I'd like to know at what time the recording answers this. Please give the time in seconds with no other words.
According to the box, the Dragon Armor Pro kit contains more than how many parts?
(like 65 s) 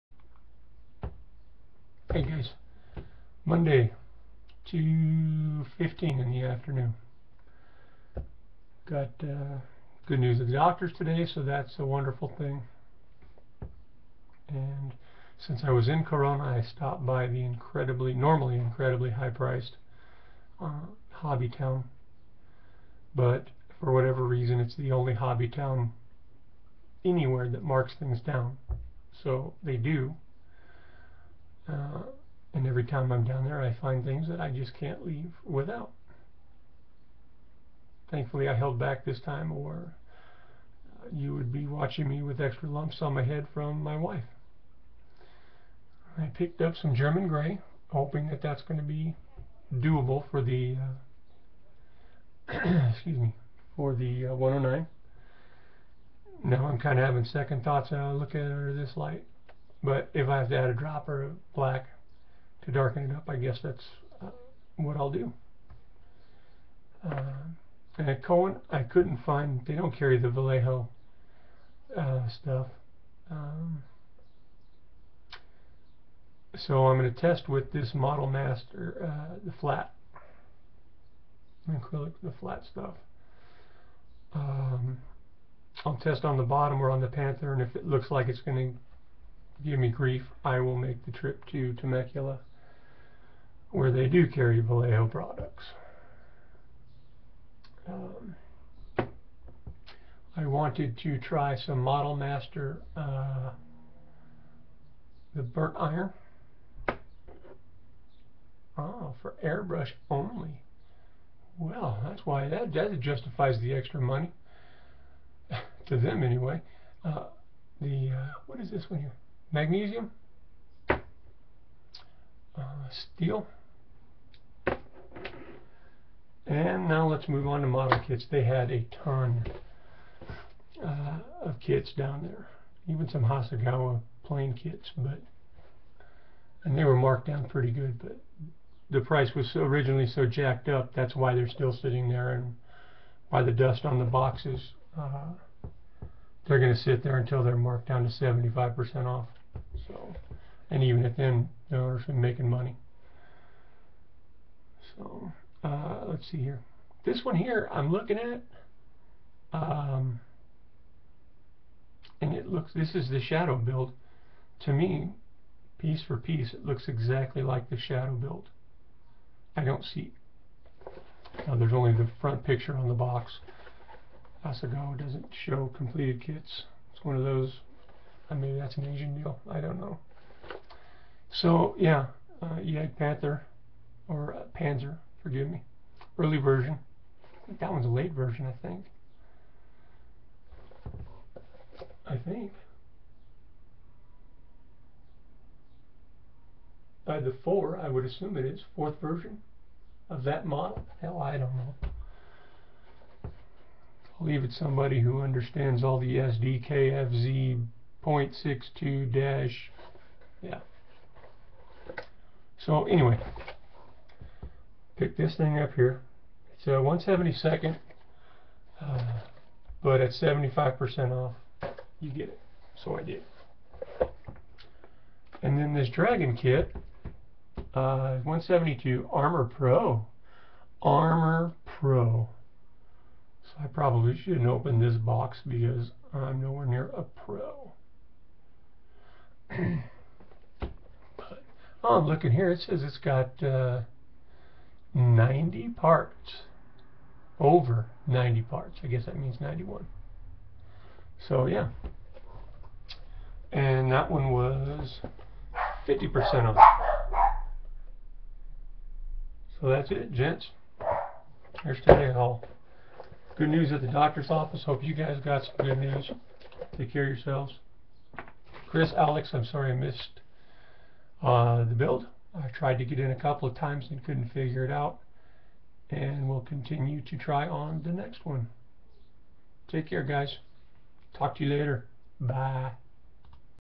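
247 s.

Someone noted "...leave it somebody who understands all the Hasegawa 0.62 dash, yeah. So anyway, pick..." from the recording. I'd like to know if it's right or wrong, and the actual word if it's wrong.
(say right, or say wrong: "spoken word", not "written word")
wrong: "SDKFZ", not "Hasegawa".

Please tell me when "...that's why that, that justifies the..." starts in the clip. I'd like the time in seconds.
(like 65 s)
112 s.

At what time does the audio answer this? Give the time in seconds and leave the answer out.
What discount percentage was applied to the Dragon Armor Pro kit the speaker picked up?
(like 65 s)
255 s.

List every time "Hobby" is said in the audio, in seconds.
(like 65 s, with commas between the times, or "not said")
21 s, 25 s.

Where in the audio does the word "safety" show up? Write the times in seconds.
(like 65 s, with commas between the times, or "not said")
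not said.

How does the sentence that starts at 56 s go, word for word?
Now I'm kind of having second thoughts.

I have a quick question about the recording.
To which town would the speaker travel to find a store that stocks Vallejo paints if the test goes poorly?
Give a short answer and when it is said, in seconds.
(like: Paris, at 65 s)
Temecula, at 91 s.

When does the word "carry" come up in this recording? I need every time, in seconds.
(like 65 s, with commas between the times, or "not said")
69 s, 94 s.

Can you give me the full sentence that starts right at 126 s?
And now let's move on to model kits.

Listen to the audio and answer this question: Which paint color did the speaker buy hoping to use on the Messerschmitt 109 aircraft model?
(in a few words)
German Grey.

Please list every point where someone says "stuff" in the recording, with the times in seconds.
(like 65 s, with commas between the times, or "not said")
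72 s, 82 s.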